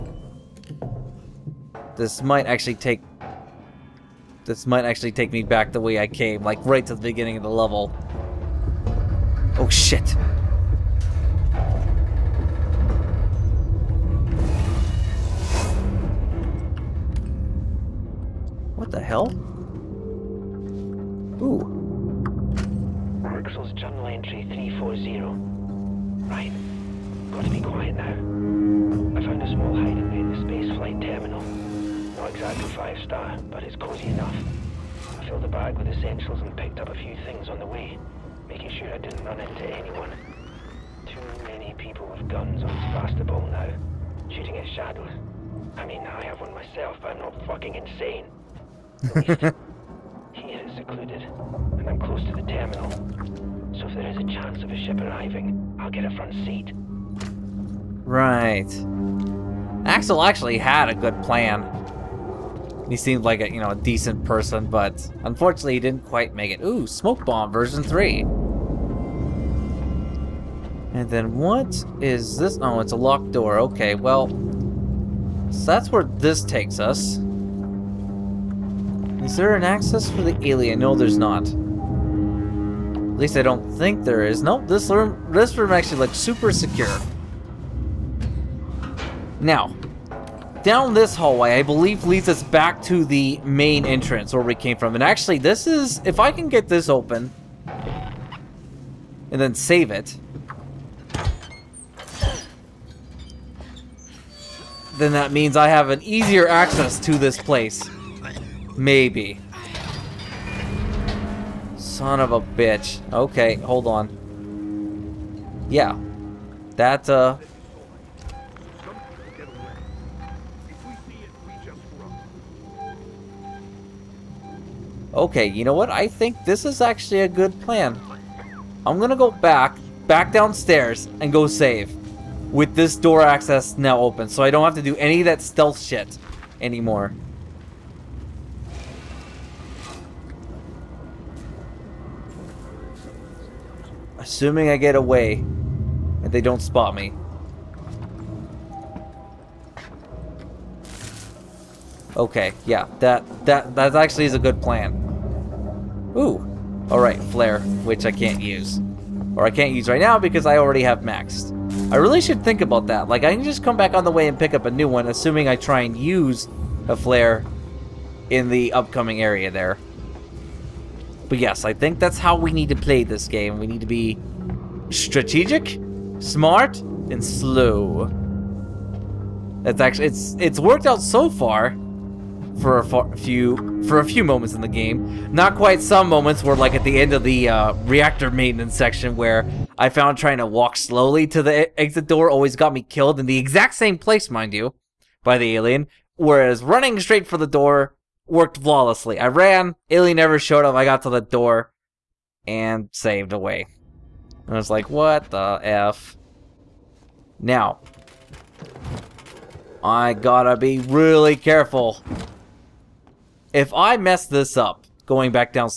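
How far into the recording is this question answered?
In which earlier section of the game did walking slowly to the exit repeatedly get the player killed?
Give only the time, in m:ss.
3:07.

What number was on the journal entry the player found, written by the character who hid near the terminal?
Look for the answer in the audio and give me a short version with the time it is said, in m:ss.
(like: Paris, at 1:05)
340, at 0:24.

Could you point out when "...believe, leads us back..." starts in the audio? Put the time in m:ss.
1:31.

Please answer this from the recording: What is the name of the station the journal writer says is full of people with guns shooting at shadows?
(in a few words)
Sebastopol.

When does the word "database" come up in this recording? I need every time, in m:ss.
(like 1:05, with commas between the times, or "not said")
not said.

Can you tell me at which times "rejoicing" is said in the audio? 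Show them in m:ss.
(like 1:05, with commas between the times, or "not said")
not said.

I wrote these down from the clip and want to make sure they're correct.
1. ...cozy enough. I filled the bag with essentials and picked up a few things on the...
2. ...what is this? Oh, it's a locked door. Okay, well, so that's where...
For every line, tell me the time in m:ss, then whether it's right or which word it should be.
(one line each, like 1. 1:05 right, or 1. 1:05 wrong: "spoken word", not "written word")
1. 0:33 right
2. 1:11 right.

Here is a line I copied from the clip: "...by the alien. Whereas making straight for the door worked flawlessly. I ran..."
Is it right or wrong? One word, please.
wrong.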